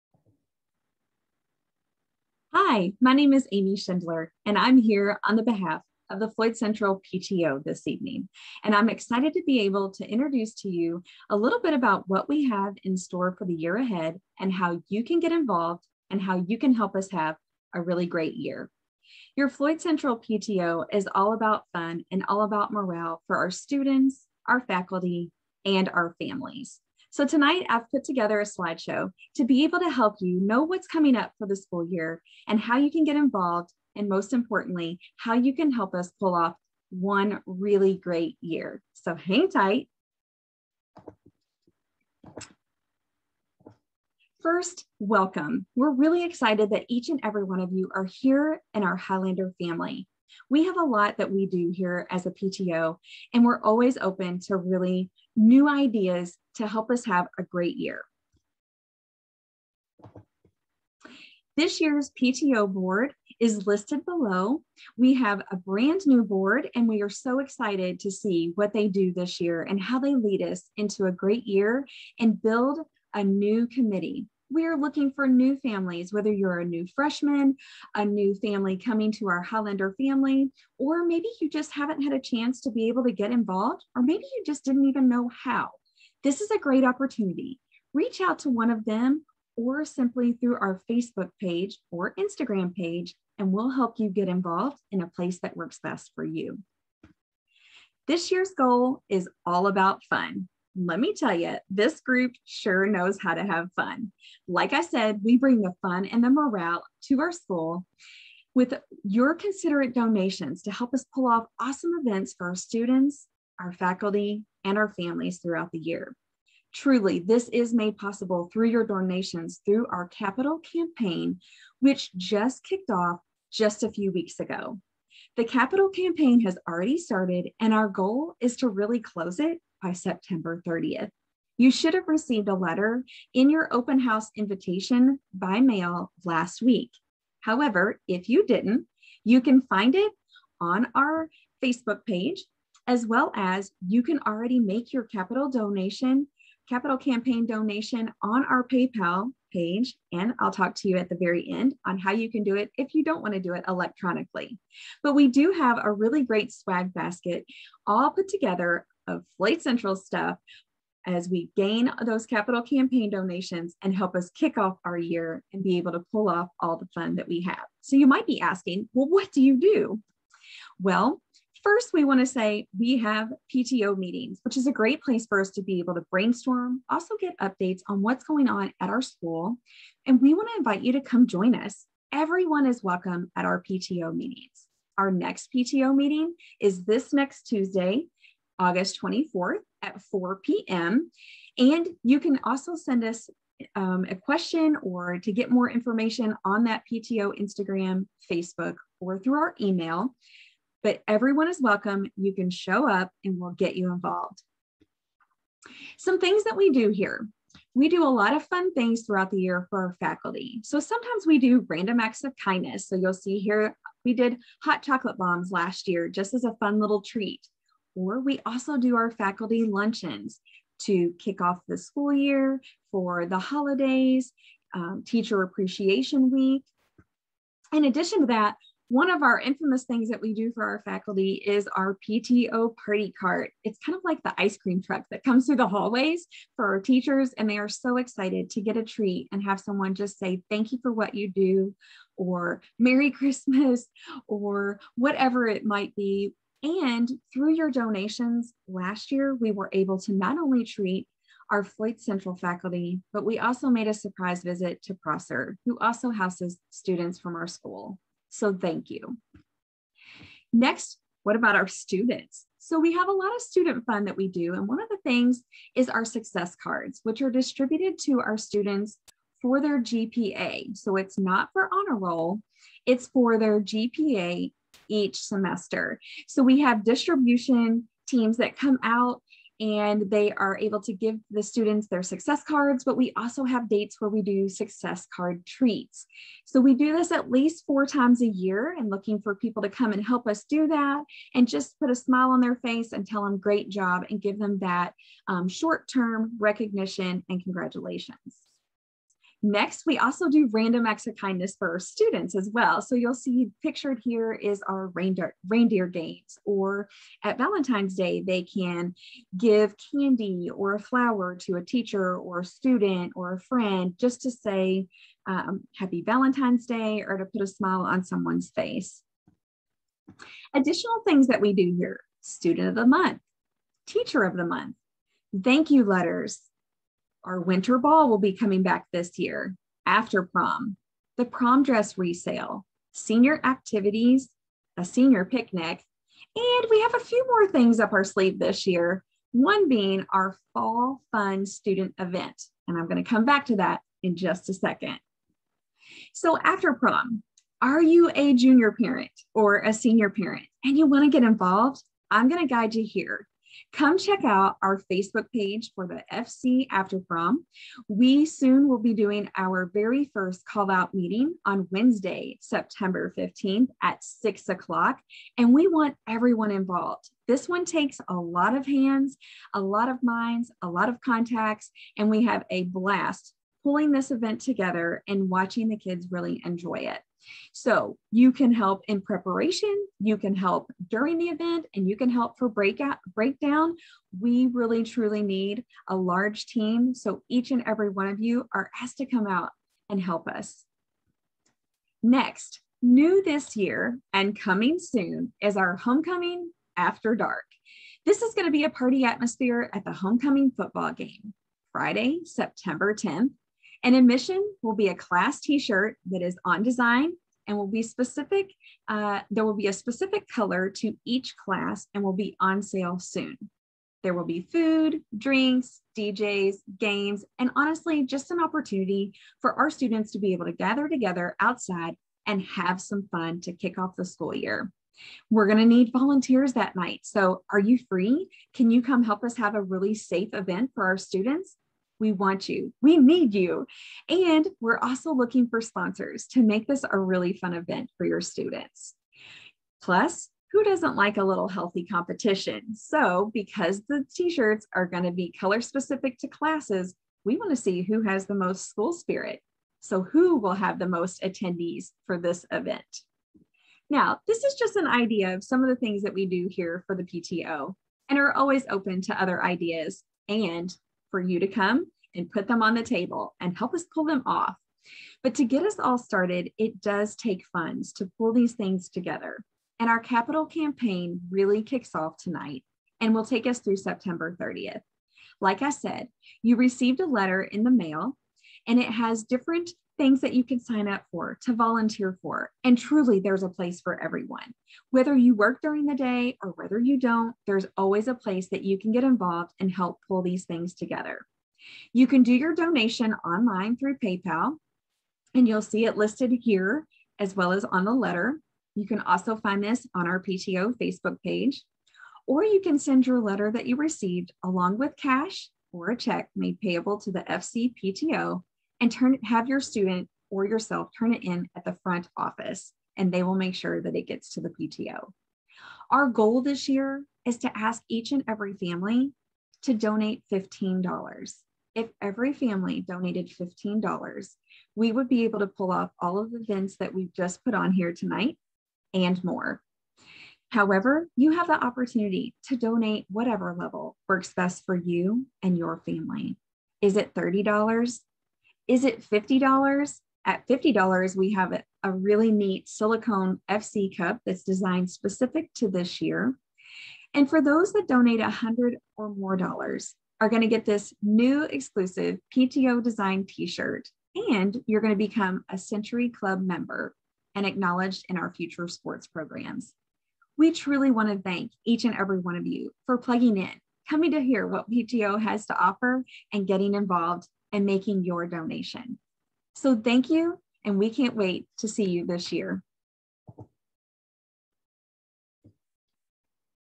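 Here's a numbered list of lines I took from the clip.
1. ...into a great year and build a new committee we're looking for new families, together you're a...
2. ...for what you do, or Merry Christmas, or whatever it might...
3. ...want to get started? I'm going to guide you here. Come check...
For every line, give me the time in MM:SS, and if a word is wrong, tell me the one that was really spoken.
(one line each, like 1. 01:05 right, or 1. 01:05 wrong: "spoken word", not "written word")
1. 01:10 wrong: "whether", not "together"
2. 04:00 right
3. 05:50 wrong: "involved", not "started".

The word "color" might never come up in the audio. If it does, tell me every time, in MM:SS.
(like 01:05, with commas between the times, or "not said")
06:50, 07:25.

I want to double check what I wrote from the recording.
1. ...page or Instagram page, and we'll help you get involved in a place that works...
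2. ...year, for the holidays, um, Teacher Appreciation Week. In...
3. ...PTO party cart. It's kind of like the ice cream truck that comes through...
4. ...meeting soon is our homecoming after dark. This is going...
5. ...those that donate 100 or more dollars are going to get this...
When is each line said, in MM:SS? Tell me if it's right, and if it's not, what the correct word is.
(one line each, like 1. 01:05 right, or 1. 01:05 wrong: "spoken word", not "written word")
1. 01:31 right
2. 03:42 right
3. 03:52 right
4. 06:34 wrong: "coming", not "meeting"
5. 09:07 right.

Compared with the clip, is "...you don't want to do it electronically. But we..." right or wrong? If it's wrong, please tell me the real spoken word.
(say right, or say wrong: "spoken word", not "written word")
right.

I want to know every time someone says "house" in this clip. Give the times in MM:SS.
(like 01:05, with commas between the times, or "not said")
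02:13, 04:16.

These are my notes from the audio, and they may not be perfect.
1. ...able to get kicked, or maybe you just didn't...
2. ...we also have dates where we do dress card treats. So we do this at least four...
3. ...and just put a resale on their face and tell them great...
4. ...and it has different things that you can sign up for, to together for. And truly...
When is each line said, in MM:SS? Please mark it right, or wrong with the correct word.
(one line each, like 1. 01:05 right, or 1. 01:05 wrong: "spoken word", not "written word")
1. 01:22 wrong: "involved", not "kicked"
2. 04:42 wrong: "success", not "dress"
3. 04:51 wrong: "smile", not "resale"
4. 07:58 wrong: "volunteer", not "together".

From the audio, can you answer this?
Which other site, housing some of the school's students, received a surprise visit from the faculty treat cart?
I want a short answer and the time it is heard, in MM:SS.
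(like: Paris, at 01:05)
Prosser, at 04:14.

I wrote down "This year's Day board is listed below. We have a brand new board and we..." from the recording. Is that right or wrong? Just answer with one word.
wrong.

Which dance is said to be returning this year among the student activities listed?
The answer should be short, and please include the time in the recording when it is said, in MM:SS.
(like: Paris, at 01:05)
Winter ball, at 05:27.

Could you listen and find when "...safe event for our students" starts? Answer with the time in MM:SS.
07:09.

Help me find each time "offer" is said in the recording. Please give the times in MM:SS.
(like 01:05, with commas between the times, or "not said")
09:25.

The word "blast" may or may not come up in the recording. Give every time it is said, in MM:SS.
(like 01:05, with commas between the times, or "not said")
06:12.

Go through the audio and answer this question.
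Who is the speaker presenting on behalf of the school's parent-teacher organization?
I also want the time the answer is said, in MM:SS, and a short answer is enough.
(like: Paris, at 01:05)
Amie Schindler, at 00:03.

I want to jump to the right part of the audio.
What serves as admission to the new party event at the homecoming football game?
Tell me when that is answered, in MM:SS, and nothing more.
06:44.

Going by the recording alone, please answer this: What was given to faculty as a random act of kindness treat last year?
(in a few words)
Hot chocolate bombs.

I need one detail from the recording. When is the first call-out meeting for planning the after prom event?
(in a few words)
Wednesday, September 15th.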